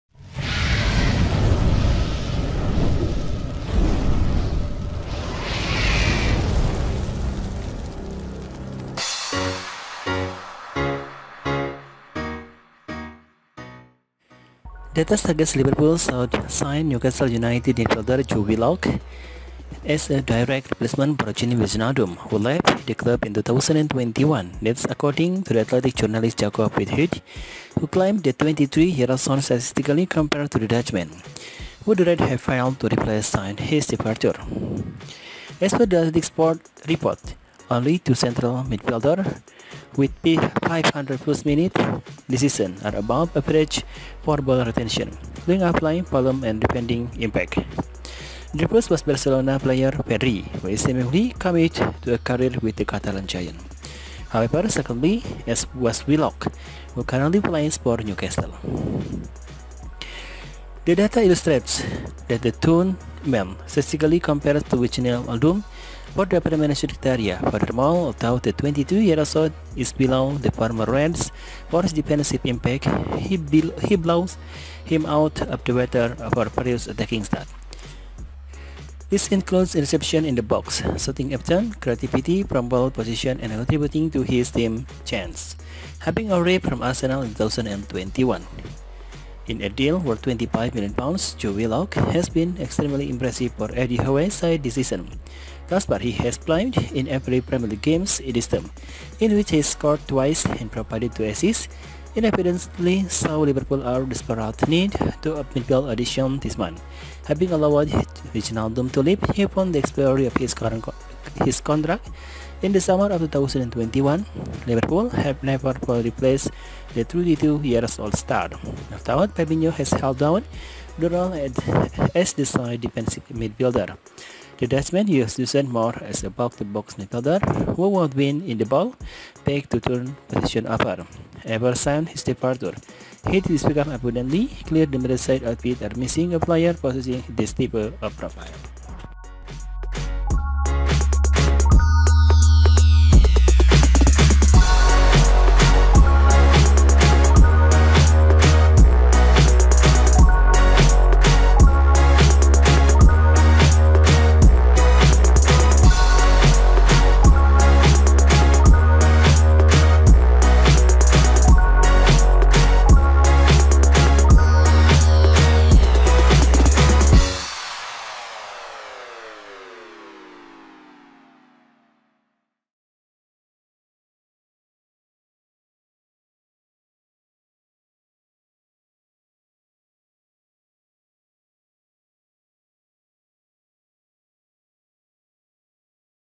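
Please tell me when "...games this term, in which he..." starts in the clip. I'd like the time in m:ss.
1:37.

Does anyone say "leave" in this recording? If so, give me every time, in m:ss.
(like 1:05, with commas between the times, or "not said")
1:48.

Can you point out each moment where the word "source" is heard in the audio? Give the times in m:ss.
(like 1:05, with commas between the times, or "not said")
not said.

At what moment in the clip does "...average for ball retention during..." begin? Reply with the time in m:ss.
0:43.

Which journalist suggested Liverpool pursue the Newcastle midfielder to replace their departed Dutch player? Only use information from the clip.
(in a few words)
Jacob Whitehead.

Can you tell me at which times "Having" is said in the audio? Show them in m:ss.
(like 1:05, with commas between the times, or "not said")
1:26, 1:47.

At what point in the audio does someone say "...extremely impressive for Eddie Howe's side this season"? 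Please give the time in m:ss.
1:32.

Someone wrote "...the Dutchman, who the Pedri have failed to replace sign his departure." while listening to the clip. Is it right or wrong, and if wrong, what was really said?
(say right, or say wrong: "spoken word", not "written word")
wrong: "Red", not "Pedri".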